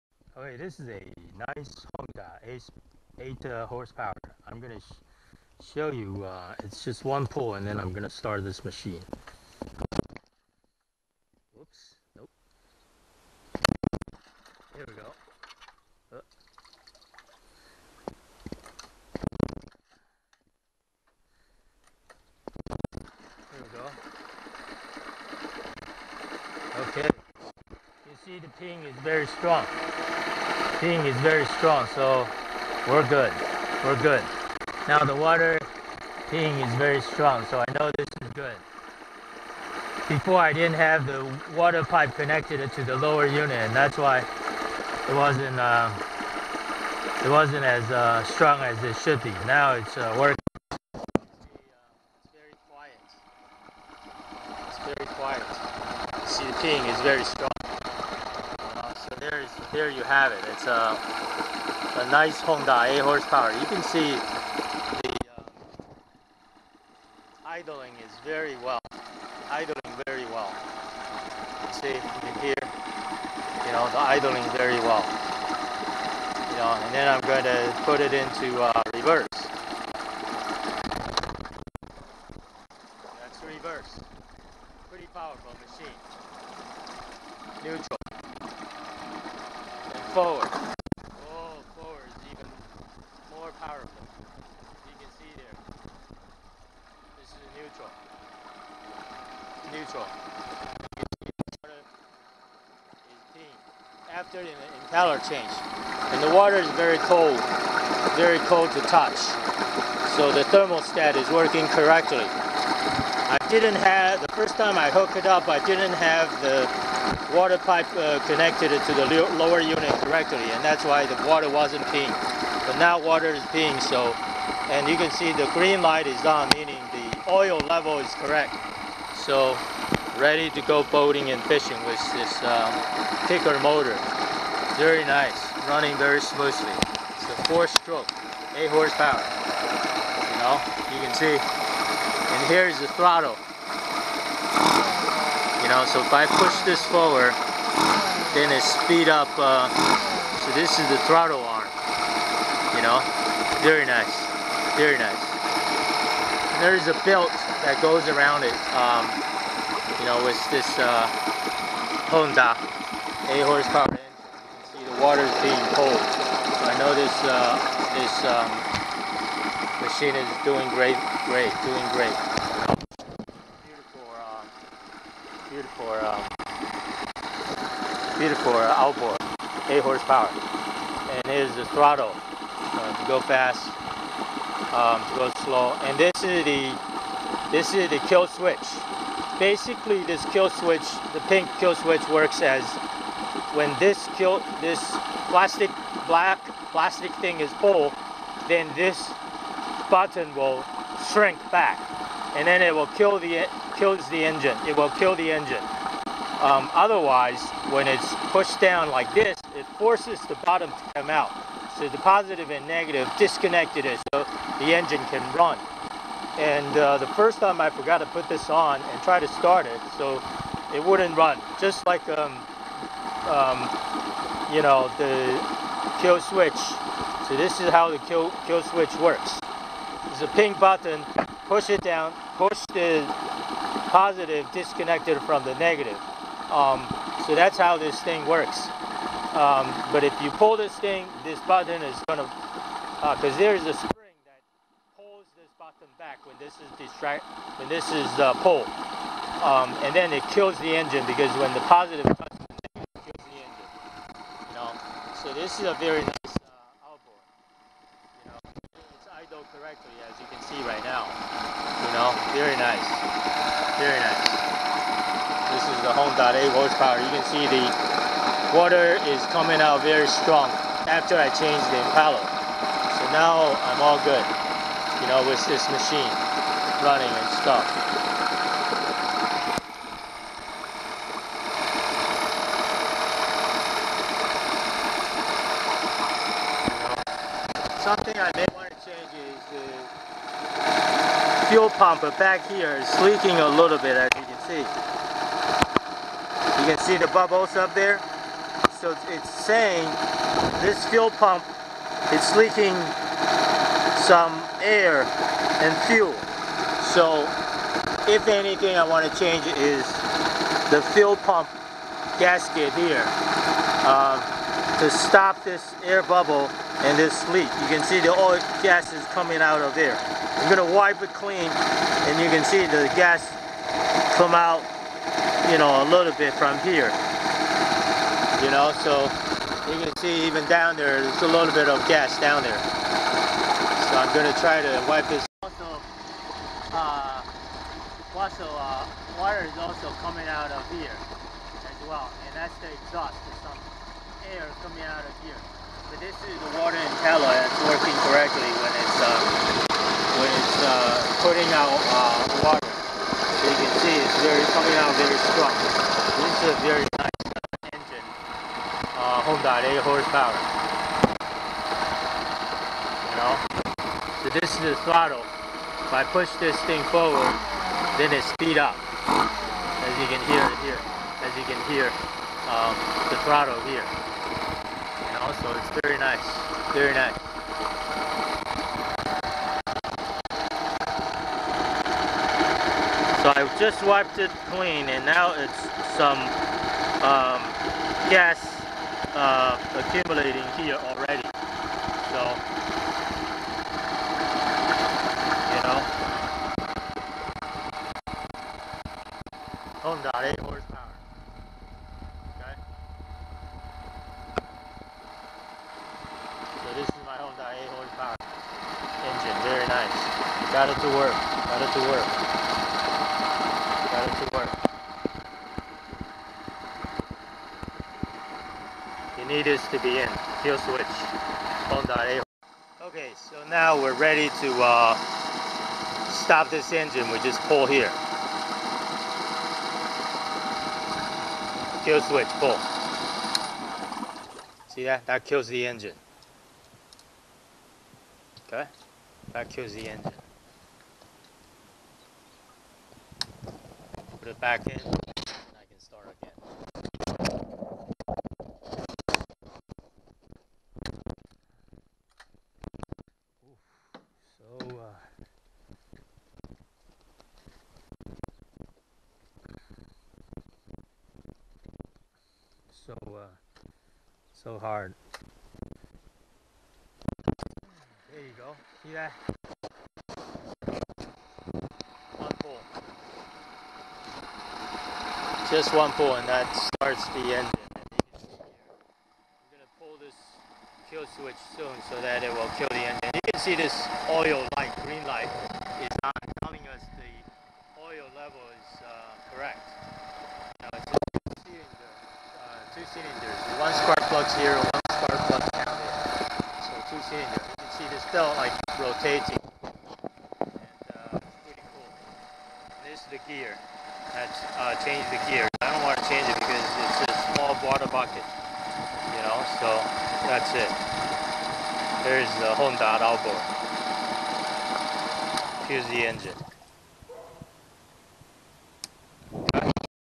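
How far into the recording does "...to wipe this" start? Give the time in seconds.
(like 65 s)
334 s.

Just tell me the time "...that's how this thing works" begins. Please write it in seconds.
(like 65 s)
237 s.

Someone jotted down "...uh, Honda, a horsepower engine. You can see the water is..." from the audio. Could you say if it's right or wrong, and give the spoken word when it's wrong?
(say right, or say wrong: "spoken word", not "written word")
right.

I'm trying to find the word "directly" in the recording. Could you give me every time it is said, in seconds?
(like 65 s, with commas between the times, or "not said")
120 s, 259 s.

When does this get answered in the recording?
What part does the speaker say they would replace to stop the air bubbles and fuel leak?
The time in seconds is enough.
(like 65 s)
310 s.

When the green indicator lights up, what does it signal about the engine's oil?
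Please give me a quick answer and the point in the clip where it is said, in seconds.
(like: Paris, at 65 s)
oil level is correct, at 127 s.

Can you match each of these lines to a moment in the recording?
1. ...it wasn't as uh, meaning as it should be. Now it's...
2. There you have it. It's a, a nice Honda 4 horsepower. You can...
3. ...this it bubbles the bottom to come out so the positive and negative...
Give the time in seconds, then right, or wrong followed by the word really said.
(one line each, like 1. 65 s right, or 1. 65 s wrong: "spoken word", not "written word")
1. 47 s wrong: "strong", not "meaning"
2. 59 s wrong: "8", not "4"
3. 209 s wrong: "forces", not "bubbles".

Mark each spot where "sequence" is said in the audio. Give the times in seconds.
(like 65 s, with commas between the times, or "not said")
not said.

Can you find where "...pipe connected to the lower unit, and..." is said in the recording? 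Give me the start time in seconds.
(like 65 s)
41 s.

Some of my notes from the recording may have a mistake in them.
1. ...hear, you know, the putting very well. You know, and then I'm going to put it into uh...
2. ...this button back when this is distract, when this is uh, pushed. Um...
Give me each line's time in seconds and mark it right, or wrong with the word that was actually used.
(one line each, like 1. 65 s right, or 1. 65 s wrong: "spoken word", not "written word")
1. 72 s wrong: "idling", not "putting"
2. 245 s wrong: "pulled", not "pushed".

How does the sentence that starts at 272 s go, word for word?
So now I'm all good, you know, with this machine running and stuff.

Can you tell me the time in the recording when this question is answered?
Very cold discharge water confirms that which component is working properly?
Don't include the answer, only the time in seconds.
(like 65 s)
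110 s.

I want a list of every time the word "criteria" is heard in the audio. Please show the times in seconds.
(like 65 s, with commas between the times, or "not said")
not said.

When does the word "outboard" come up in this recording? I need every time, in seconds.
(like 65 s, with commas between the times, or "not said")
178 s, 513 s.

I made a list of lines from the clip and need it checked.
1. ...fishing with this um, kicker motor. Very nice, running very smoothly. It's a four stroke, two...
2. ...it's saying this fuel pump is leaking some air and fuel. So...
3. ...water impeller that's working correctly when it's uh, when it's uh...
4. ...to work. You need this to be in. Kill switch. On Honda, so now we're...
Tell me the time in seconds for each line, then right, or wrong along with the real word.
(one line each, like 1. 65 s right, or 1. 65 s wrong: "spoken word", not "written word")
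1. 131 s wrong: "eight", not "two"
2. 299 s right
3. 346 s right
4. 414 s wrong: "Okay", not "Honda".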